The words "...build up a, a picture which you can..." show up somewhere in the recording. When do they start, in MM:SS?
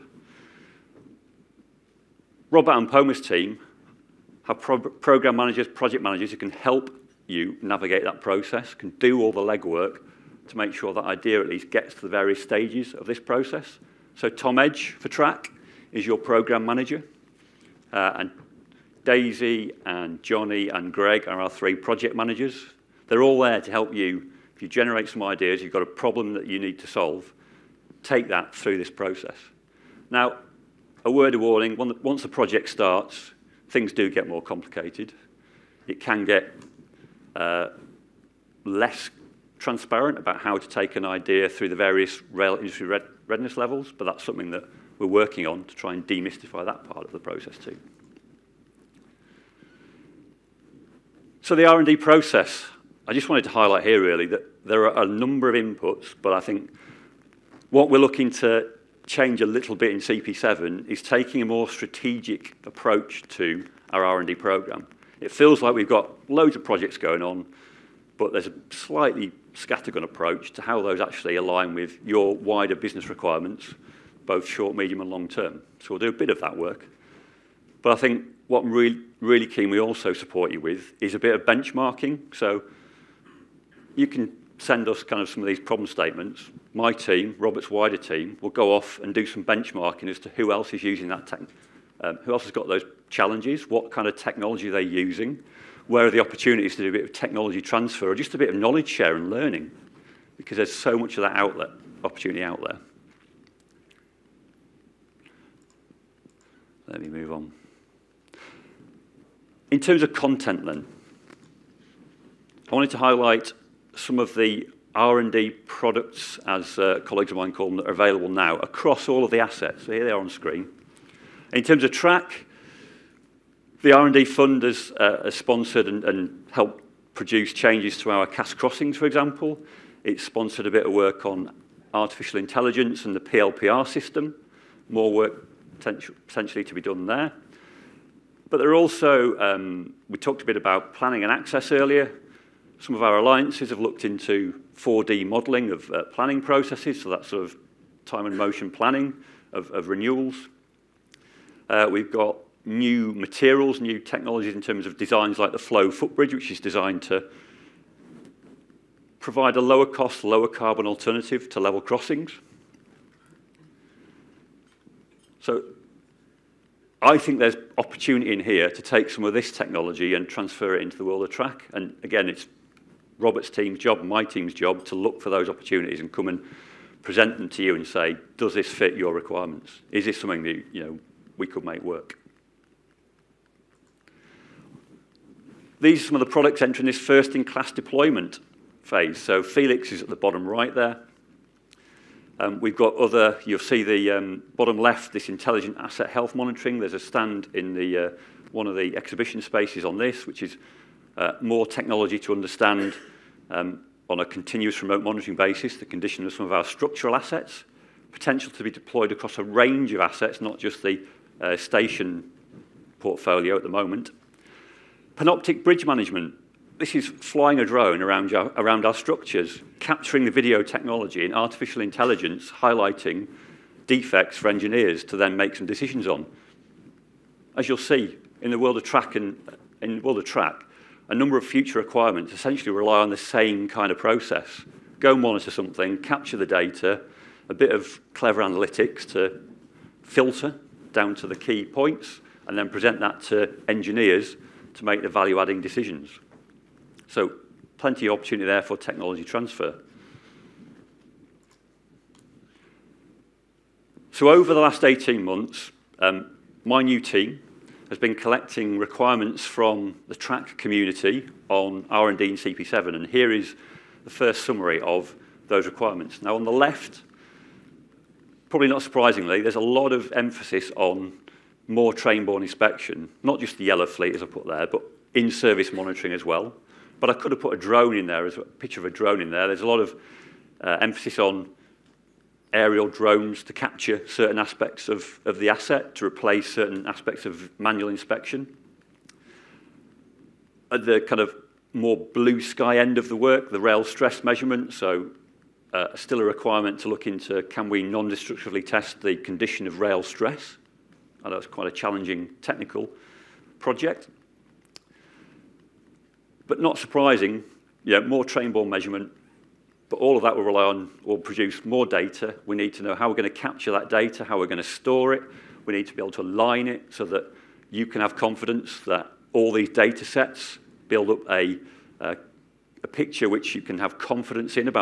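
05:20.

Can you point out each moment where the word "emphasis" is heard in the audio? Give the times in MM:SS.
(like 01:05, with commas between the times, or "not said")
04:30, 04:40.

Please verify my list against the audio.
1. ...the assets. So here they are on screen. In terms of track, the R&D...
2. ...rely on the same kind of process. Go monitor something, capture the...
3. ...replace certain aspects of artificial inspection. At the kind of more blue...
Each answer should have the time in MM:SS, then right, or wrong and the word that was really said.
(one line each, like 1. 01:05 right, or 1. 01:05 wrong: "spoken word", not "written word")
1. 01:59 right
2. 03:52 right
3. 04:46 wrong: "manual", not "artificial".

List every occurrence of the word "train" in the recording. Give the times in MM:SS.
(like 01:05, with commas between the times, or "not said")
04:31, 05:08.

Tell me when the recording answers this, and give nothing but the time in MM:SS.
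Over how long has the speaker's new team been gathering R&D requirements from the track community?
04:14.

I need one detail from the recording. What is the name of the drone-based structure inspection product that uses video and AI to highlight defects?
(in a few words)
Panoptic bridge management.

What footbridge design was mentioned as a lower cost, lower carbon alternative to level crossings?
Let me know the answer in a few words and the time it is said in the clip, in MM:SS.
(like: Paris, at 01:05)
flow footbridge, at 02:35.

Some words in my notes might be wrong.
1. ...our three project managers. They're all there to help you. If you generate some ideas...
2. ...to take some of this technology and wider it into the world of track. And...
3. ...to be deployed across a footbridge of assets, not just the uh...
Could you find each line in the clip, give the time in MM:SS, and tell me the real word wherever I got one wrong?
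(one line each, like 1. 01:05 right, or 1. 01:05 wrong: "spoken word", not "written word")
1. 00:21 right
2. 02:48 wrong: "transfer", not "wider"
3. 03:28 wrong: "range", not "footbridge".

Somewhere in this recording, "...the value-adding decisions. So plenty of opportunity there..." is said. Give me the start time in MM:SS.
04:05.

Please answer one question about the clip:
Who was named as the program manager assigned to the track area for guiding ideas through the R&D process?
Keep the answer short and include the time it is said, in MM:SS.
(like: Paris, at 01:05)
Tom Edge, at 00:14.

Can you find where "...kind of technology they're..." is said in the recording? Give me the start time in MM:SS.
01:33.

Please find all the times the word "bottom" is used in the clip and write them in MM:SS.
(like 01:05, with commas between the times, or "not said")
03:10, 03:14.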